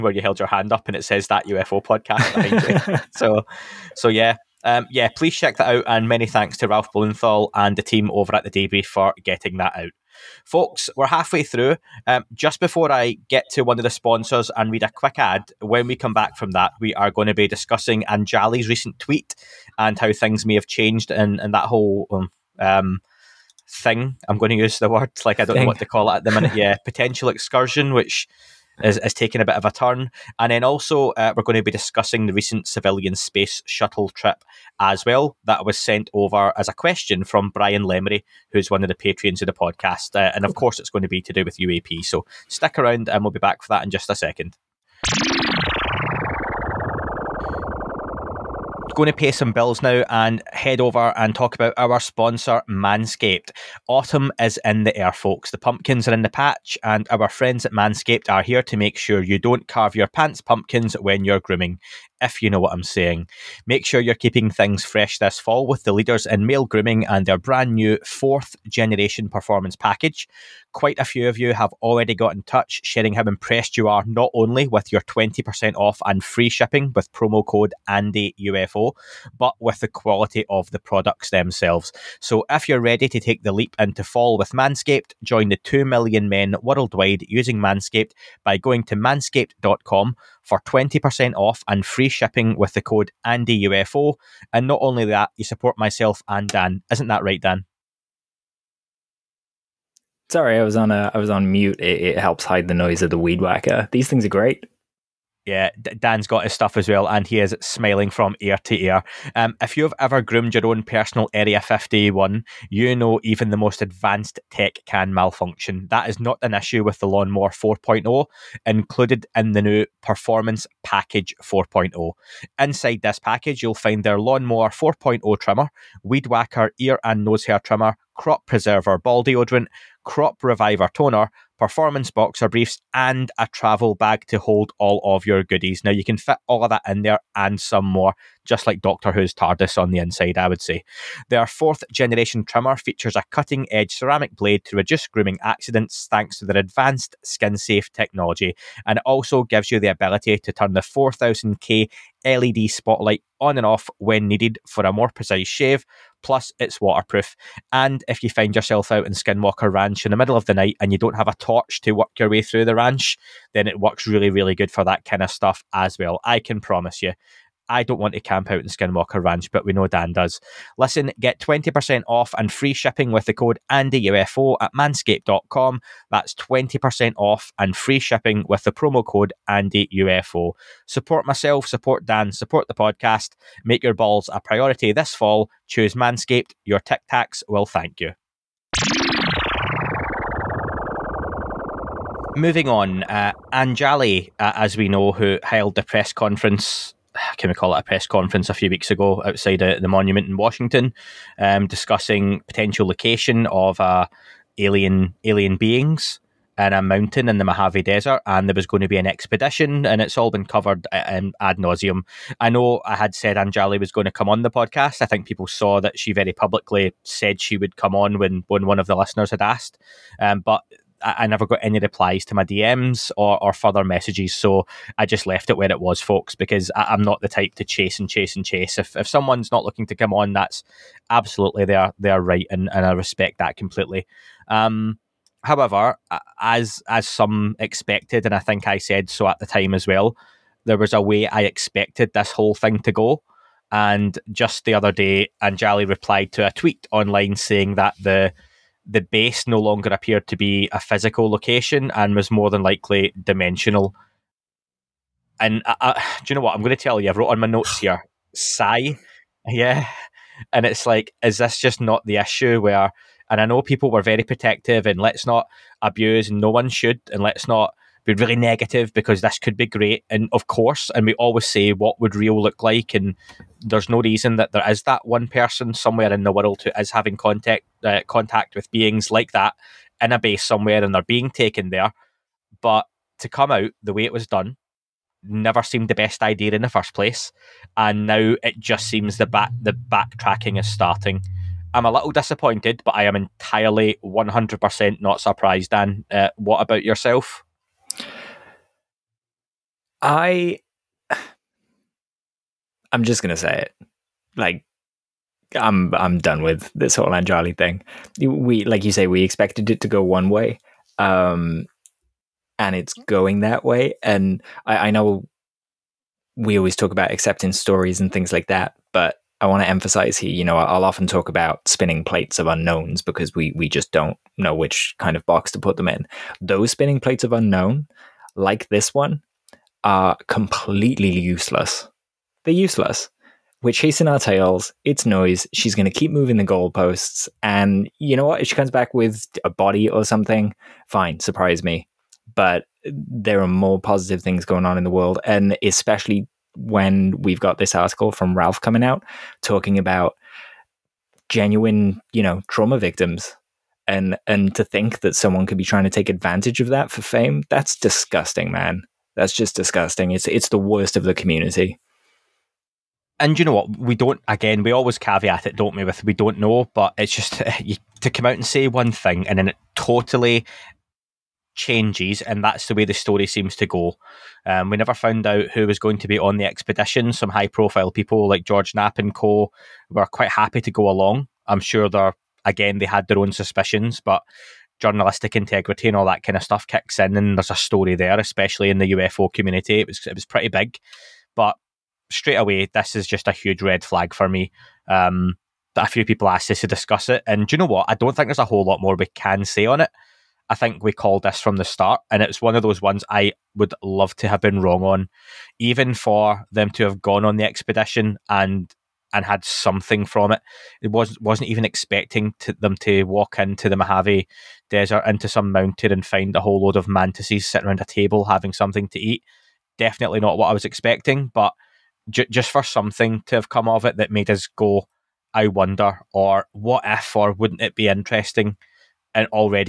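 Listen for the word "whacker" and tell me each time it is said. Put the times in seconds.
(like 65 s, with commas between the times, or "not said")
103 s, 126 s.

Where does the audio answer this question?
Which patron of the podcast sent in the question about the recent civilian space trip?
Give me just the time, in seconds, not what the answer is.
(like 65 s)
37 s.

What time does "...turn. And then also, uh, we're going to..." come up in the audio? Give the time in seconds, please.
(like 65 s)
29 s.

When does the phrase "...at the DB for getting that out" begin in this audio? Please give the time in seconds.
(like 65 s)
8 s.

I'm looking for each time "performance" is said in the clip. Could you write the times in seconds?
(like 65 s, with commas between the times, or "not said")
69 s, 120 s, 131 s.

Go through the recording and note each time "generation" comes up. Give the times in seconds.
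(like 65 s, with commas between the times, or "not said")
68 s, 141 s.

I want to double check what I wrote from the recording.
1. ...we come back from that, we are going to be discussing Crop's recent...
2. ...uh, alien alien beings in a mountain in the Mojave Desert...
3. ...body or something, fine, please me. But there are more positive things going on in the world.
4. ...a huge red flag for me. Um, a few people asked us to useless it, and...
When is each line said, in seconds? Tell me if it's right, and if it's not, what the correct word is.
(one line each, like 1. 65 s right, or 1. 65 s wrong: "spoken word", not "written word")
1. 15 s wrong: "Anjali", not "Crop"
2. 203 s right
3. 339 s wrong: "surprise", not "please"
4. 393 s wrong: "discuss", not "useless".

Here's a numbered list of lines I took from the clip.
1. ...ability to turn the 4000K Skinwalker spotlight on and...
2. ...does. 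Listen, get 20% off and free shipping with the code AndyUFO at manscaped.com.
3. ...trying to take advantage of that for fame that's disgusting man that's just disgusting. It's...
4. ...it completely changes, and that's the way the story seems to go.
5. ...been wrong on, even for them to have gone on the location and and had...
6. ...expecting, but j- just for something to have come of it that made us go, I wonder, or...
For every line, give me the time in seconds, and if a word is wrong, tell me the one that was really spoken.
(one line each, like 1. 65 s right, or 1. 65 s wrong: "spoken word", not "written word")
1. 149 s wrong: "LED", not "Skinwalker"
2. 170 s right
3. 355 s right
4. 369 s wrong: "totally", not "completely"
5. 404 s wrong: "expedition", not "location"
6. 420 s right.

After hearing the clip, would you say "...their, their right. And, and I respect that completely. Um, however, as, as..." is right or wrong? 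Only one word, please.
right.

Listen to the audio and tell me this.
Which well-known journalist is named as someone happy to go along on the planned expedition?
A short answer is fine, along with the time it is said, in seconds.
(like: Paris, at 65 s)
George Knapp, at 378 s.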